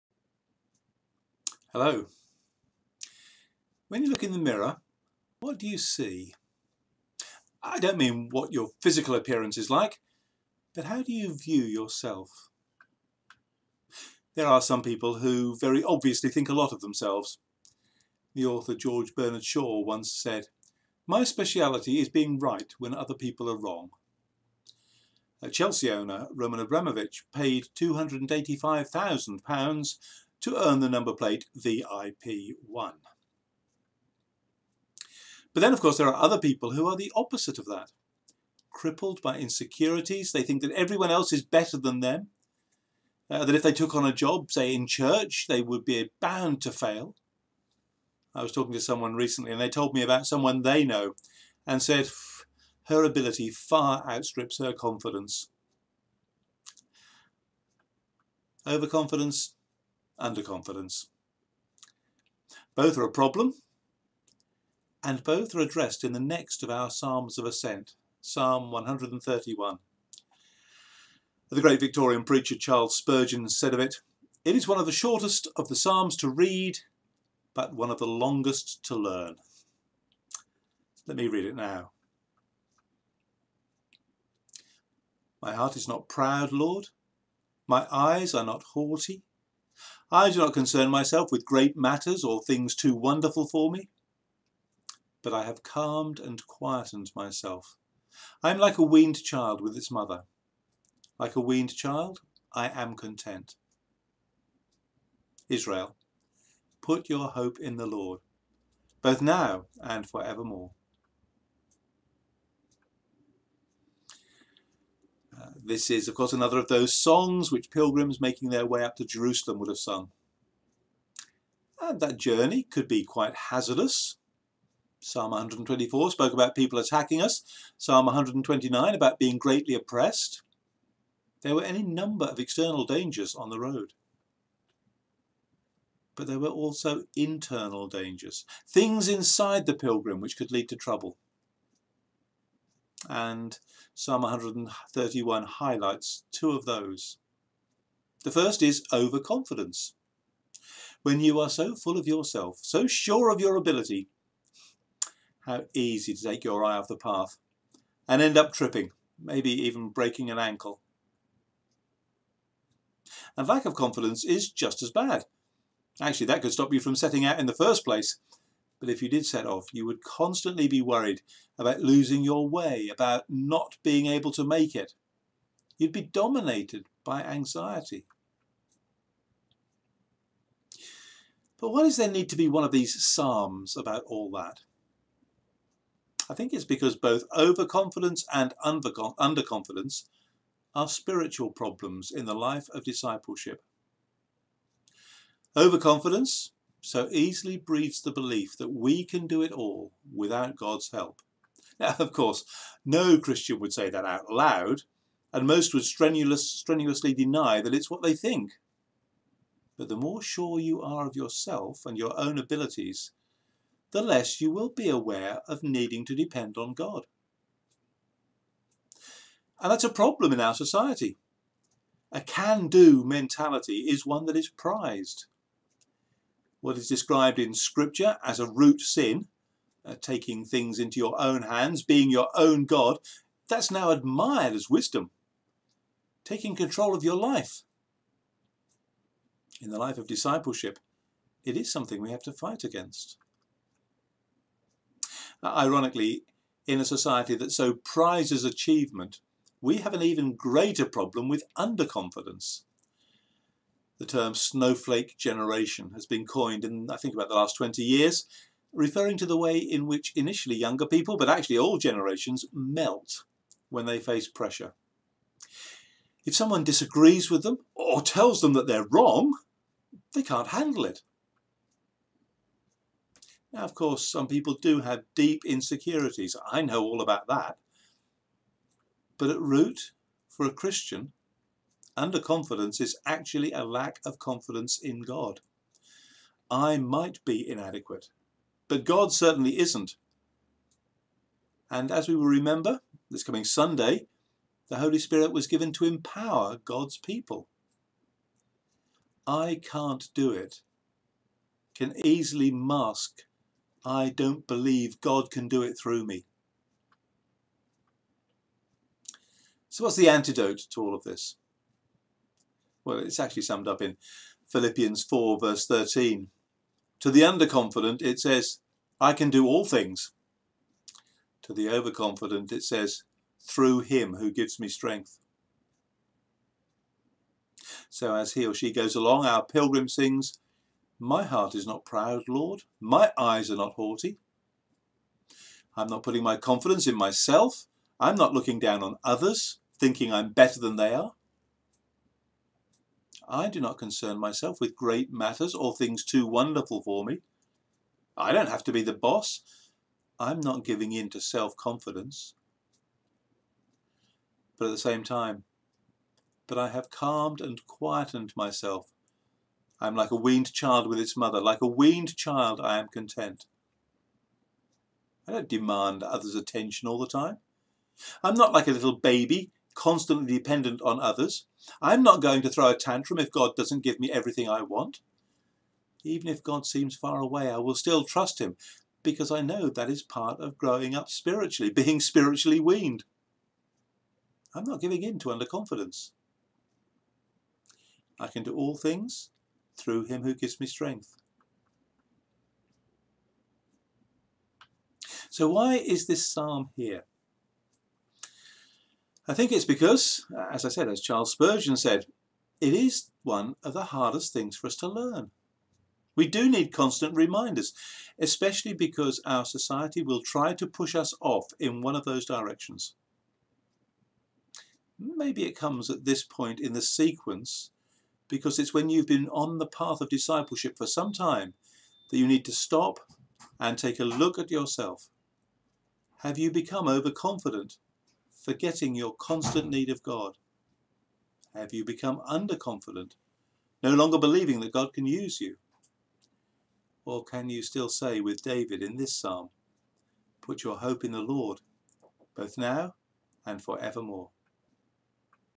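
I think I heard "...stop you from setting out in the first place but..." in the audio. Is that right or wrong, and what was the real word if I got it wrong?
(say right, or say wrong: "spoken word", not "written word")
right.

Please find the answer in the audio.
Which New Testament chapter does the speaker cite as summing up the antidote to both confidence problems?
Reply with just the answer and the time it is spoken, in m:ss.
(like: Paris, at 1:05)
Philippians 4, at 5:14.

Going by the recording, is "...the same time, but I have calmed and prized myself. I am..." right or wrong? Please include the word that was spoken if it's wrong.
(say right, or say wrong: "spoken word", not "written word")
wrong: "quietened", not "prized".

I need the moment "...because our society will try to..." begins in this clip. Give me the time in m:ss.
6:48.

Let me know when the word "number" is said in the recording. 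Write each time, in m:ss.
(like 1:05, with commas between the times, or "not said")
0:30, 2:11.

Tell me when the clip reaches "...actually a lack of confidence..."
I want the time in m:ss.
4:43.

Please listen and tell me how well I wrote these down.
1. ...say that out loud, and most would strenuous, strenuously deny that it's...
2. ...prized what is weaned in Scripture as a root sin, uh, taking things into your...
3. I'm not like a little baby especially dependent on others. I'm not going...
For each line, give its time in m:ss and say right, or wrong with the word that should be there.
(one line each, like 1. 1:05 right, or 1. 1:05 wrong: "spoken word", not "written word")
1. 3:23 right
2. 3:44 wrong: "described", not "weaned"
3. 6:08 wrong: "constantly", not "especially".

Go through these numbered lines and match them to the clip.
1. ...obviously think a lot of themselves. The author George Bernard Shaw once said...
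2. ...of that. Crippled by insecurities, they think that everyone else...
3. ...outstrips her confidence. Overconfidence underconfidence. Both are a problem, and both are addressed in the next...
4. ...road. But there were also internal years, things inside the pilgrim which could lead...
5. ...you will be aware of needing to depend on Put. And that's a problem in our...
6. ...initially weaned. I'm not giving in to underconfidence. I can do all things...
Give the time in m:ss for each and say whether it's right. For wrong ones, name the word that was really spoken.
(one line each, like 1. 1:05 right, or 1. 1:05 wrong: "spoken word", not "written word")
1. 0:15 right
2. 0:37 right
3. 0:54 right
4. 2:13 wrong: "dangers", not "years"
5. 3:34 wrong: "God", not "Put"
6. 6:21 wrong: "spiritually", not "initially".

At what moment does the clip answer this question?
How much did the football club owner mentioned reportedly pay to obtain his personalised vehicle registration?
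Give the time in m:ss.
0:27.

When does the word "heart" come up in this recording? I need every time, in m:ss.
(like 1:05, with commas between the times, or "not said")
1:25, 5:31.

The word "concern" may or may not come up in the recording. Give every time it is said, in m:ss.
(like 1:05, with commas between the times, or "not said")
1:30, 5:43.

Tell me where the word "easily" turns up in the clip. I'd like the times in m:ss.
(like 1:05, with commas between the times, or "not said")
3:17, 5:02.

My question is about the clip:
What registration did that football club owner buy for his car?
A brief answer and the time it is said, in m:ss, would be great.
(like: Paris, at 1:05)
VIP1, at 0:31.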